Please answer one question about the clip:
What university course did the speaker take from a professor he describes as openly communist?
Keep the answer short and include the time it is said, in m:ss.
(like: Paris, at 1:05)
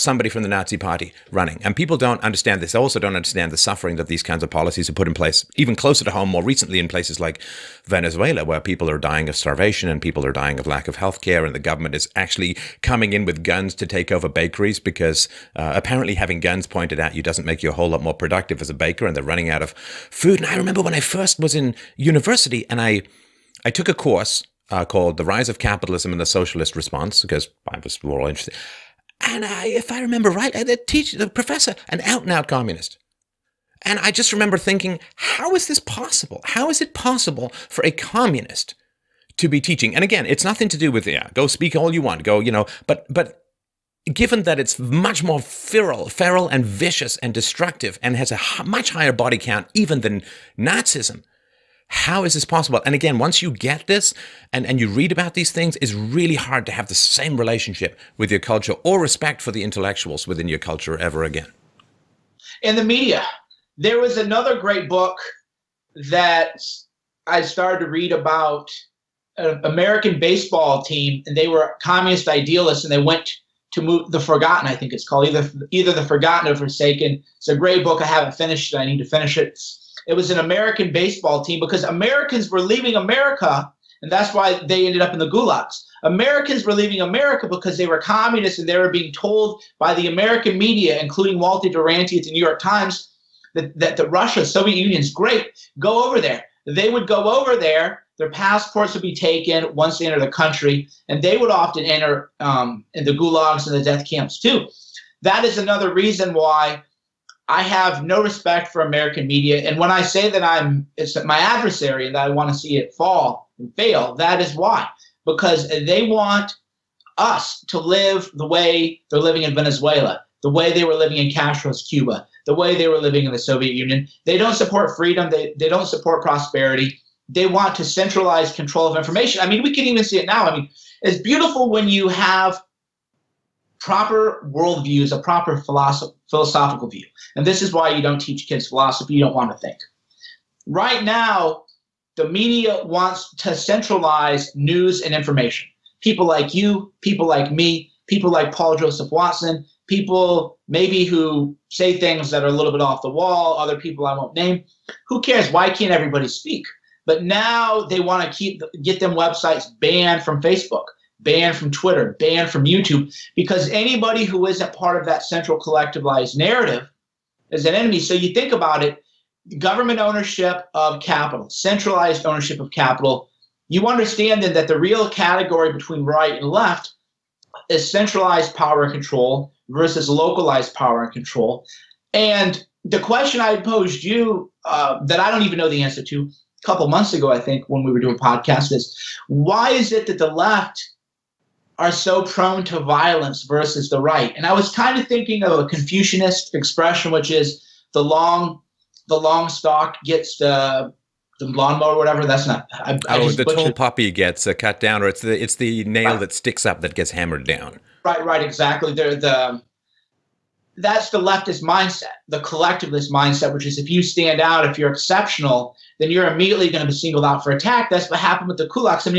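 The Rise of Capitalism and the Socialist Response, at 0:25.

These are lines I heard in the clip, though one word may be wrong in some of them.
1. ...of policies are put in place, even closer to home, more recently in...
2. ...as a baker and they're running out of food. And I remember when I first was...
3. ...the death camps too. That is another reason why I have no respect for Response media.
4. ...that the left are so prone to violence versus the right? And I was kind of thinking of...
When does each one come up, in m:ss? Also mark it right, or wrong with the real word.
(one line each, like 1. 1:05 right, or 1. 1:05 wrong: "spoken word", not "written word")
1. 0:04 right
2. 0:18 right
3. 1:43 wrong: "American", not "Response"
4. 3:10 right.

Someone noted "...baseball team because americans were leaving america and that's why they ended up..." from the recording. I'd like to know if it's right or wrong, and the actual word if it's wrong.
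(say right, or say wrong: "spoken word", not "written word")
right.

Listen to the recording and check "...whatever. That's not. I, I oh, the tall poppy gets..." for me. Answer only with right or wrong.
right.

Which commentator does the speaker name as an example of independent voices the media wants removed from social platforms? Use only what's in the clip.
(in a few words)
Paul Joseph Watson.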